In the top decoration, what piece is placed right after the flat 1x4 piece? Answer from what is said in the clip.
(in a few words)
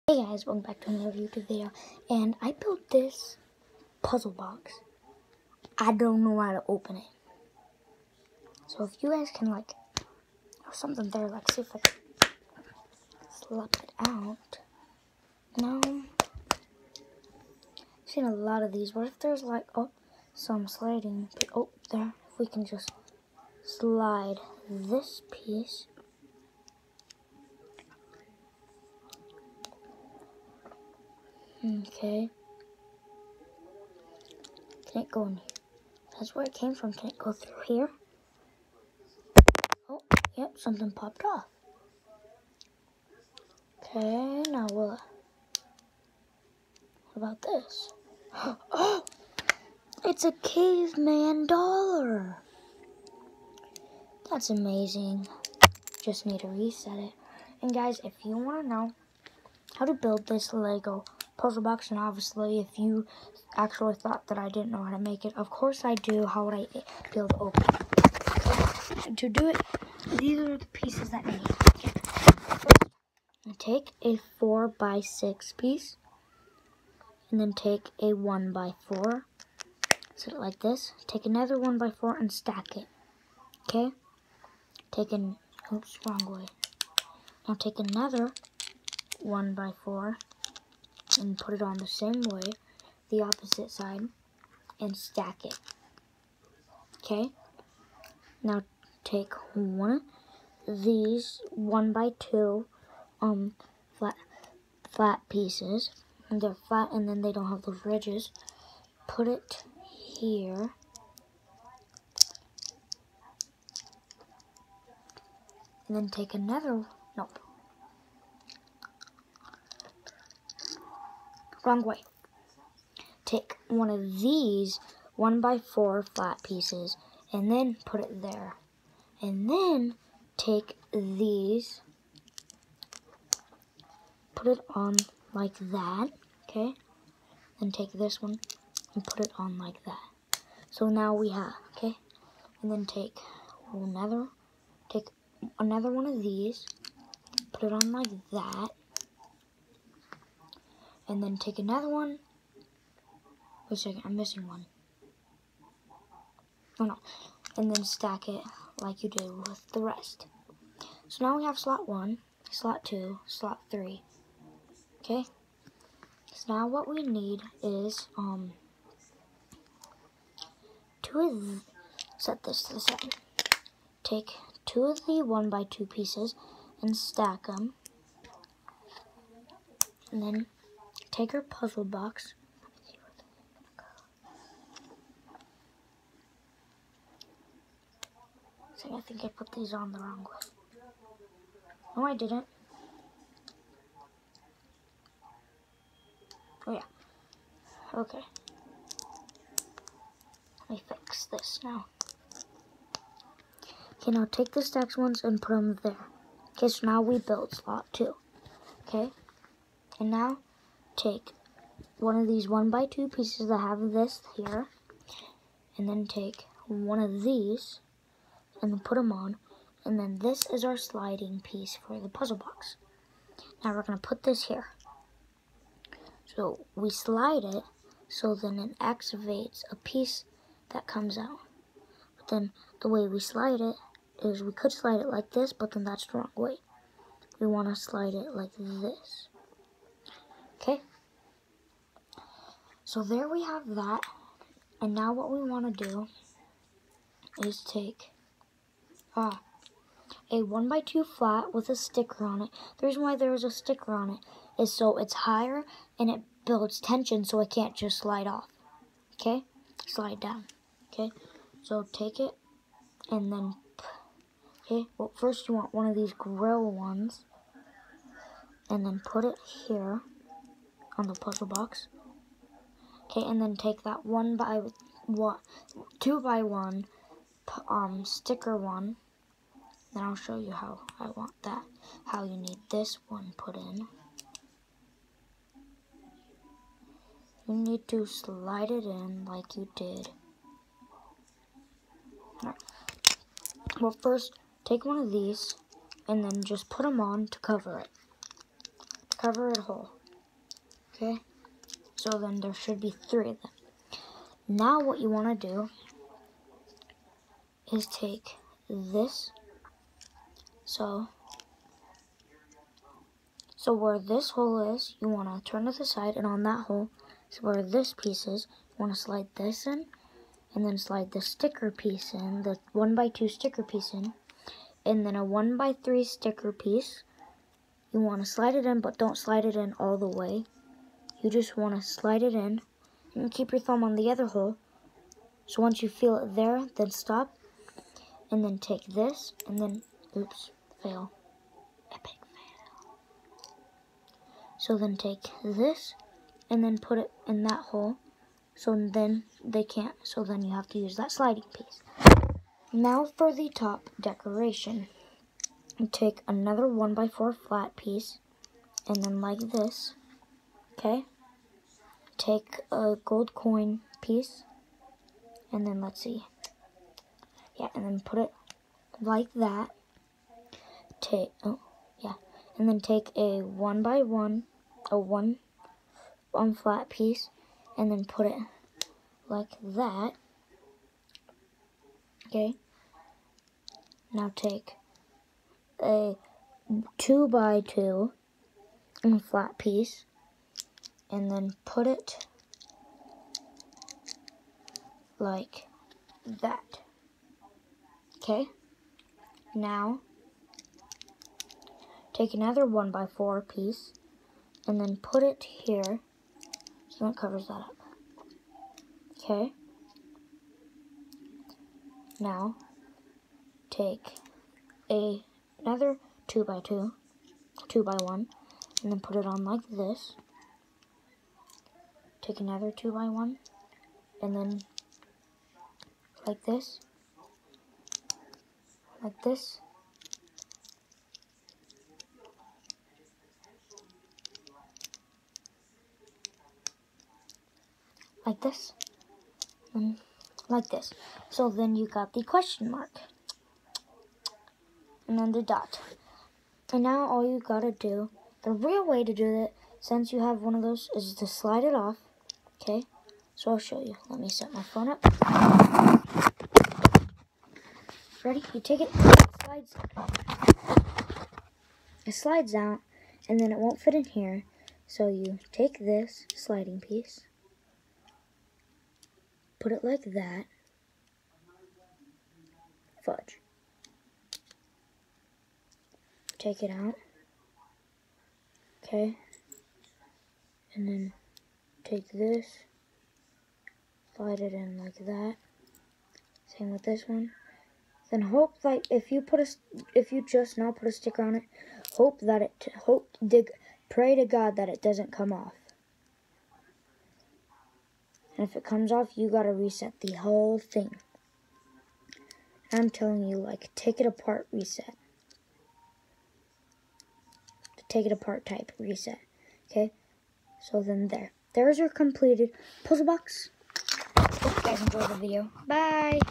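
A gold coin piece.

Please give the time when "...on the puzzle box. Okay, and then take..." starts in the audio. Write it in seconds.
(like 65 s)
270 s.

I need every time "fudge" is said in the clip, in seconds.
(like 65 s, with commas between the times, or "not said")
473 s.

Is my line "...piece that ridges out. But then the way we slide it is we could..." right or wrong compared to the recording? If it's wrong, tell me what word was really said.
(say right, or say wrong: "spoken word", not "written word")
wrong: "comes", not "ridges".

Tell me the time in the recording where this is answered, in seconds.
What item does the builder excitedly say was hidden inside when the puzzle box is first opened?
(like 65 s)
50 s.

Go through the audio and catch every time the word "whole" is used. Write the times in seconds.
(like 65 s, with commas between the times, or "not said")
299 s, 500 s.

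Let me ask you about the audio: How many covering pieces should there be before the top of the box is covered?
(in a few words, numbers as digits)
3.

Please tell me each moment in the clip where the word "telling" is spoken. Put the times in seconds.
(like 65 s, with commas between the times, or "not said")
502 s.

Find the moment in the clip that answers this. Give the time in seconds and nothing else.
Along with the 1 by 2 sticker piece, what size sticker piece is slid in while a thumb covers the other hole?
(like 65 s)
325 s.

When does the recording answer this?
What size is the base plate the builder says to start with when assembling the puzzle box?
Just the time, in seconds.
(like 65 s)
74 s.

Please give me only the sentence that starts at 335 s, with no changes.
So once you feel it there, then stop and then take this and then, oops, fail, epic fail.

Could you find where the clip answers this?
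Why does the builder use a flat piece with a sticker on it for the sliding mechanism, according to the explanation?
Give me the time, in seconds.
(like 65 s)
256 s.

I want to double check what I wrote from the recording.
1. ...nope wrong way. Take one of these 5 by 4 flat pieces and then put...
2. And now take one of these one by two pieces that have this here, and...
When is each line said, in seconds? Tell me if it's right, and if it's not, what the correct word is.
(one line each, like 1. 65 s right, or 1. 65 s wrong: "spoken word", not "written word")
1. 117 s wrong: "1", not "5"
2. 209 s right.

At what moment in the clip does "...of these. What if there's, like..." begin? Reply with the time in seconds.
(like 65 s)
18 s.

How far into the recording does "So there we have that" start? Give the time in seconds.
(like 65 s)
242 s.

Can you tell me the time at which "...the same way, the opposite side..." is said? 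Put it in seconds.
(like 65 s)
91 s.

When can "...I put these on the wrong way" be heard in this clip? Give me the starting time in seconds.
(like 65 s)
189 s.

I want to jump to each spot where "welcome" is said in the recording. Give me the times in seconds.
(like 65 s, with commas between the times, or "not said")
0 s.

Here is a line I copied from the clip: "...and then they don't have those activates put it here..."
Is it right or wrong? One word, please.
wrong.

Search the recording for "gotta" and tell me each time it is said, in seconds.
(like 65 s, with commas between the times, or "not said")
447 s, 499 s.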